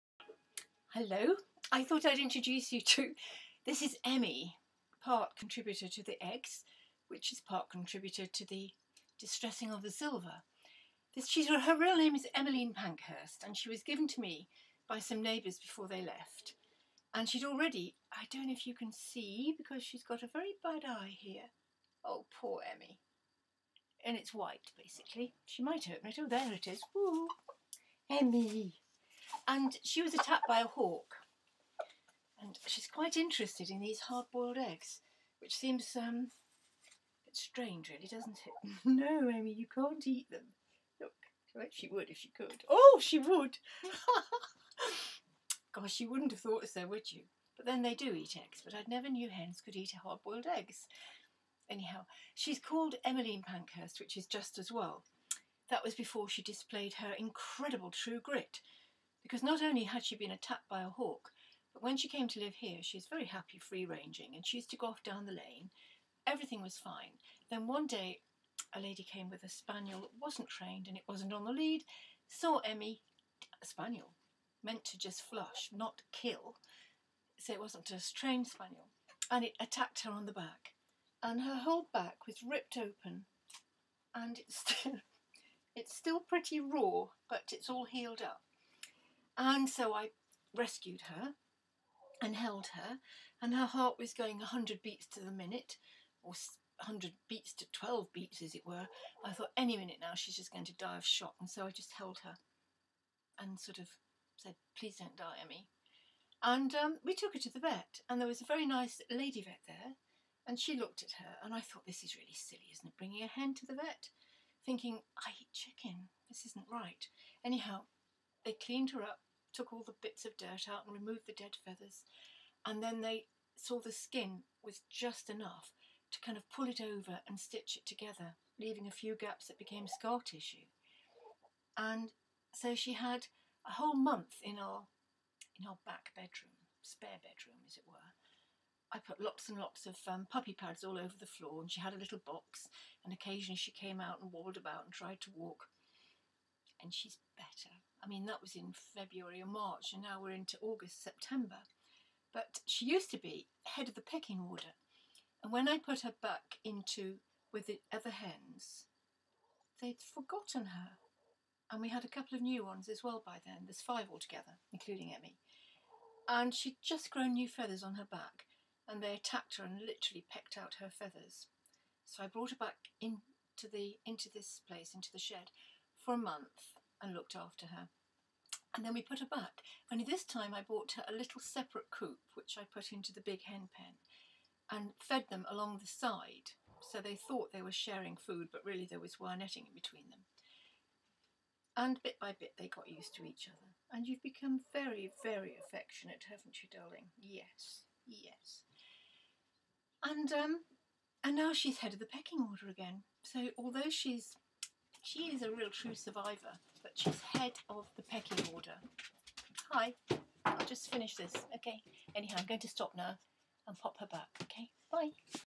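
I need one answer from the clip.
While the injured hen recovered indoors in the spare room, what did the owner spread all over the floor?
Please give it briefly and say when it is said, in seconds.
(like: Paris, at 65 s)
puppy pads, at 140 s.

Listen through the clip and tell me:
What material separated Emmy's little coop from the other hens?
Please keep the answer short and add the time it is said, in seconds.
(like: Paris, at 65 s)
wire netting, at 189 s.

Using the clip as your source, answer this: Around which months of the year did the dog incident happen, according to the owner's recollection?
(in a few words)
February or March.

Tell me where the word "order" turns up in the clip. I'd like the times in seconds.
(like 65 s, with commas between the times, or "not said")
154 s, 202 s, 208 s.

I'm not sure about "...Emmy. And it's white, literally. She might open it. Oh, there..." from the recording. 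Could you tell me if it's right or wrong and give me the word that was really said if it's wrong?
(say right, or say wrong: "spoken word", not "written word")
wrong: "basically", not "literally".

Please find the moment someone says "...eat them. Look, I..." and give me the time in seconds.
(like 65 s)
40 s.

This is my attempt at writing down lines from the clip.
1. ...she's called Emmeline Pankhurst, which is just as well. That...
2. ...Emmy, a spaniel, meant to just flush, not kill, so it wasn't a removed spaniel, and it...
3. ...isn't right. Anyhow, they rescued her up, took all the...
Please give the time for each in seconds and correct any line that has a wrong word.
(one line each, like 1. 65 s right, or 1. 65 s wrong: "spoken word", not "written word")
1. 52 s right
2. 72 s wrong: "trained", not "removed"
3. 116 s wrong: "cleaned", not "rescued".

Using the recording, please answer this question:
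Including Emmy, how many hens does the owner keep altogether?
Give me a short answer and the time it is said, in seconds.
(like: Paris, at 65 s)
5, at 163 s.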